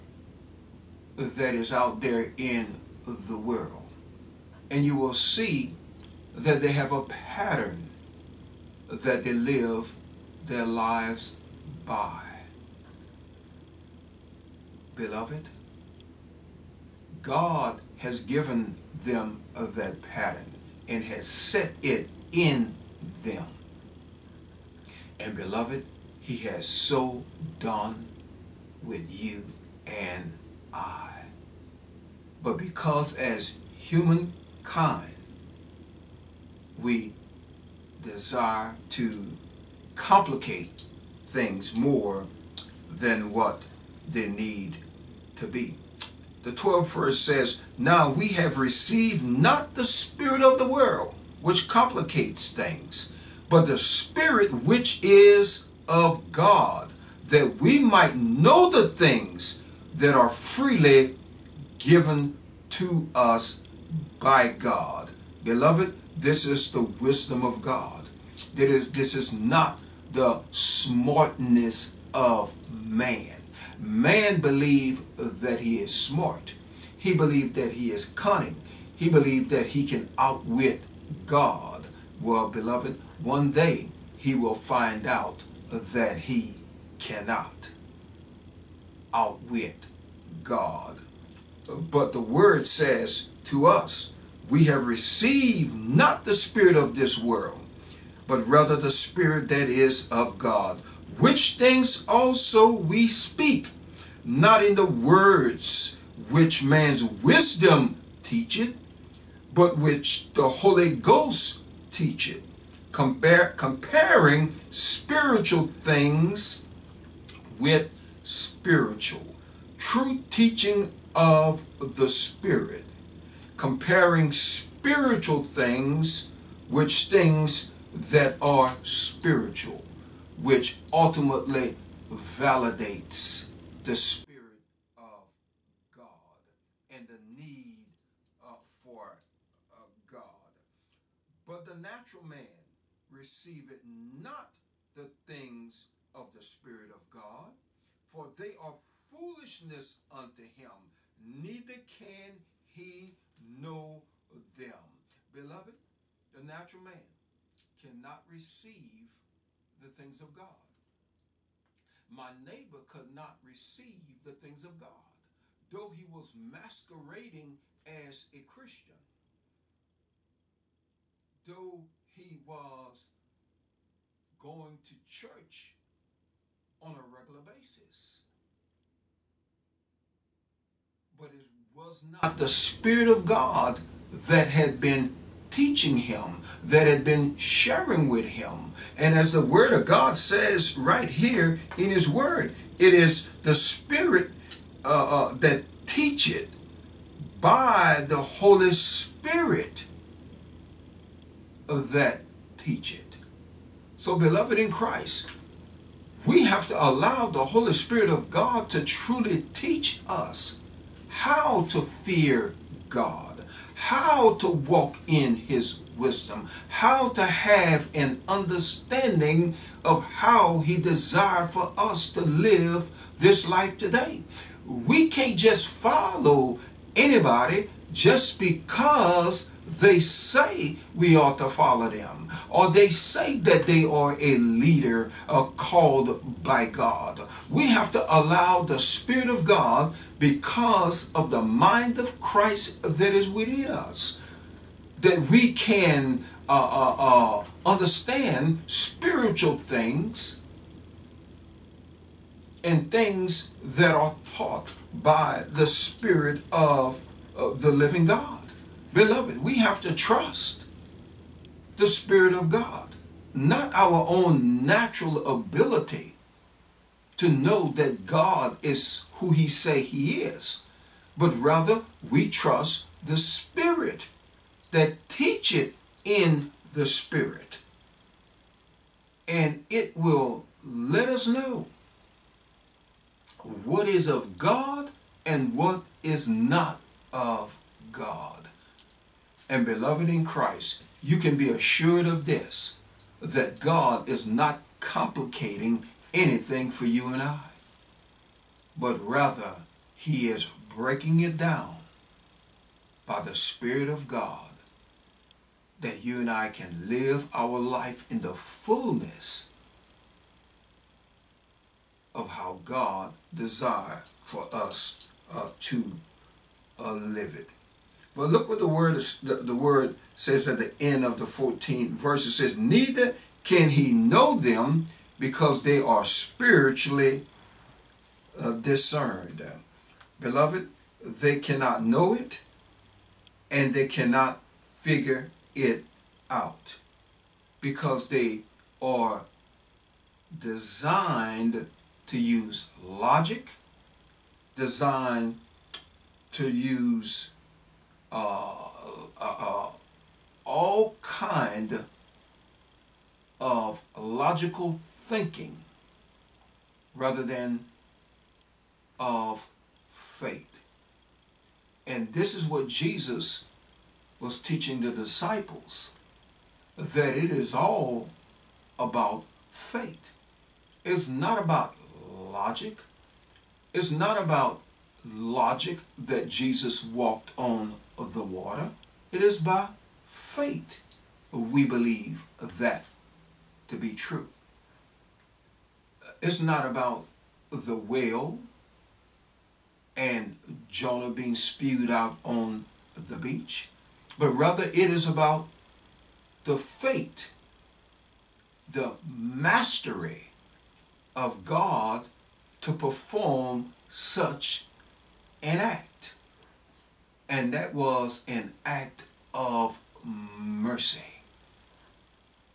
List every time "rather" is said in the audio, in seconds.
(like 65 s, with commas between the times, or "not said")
98 s, 271 s, 299 s, 356 s, 394 s.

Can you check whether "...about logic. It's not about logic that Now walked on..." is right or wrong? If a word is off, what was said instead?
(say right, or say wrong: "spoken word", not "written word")
wrong: "Jesus", not "Now".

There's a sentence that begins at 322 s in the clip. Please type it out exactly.
It says, neither can he know them because they are spiritually uh, discerned.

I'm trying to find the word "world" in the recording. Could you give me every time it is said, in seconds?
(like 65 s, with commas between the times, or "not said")
3 s, 50 s, 97 s.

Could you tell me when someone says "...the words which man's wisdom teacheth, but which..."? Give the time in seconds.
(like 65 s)
104 s.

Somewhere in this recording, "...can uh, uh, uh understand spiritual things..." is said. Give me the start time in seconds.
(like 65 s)
245 s.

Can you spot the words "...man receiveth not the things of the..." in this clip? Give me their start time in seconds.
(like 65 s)
142 s.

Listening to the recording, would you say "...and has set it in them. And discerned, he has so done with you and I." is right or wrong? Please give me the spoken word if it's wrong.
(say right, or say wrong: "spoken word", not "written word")
wrong: "beloved", not "discerned".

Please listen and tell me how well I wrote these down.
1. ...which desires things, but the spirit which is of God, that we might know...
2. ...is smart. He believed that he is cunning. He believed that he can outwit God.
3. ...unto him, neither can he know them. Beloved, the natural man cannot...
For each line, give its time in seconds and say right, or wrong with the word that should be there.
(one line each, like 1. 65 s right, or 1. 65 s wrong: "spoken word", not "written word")
1. 51 s wrong: "complicates", not "desires"
2. 75 s right
3. 150 s right.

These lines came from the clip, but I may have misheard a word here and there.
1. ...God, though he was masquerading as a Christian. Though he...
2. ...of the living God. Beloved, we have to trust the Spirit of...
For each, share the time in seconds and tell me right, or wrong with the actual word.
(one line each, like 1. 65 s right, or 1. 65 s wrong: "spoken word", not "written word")
1. 164 s right
2. 256 s right.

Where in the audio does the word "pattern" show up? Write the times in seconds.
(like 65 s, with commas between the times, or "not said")
7 s, 20 s.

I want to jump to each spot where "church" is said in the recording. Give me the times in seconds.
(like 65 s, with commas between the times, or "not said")
175 s.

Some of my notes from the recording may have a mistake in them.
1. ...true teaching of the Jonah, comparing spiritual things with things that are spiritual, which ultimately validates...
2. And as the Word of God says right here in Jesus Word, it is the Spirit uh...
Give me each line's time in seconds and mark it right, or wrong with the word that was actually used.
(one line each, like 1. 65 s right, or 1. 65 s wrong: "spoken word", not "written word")
1. 119 s wrong: "Spirit", not "Jonah"
2. 188 s wrong: "His", not "Jesus".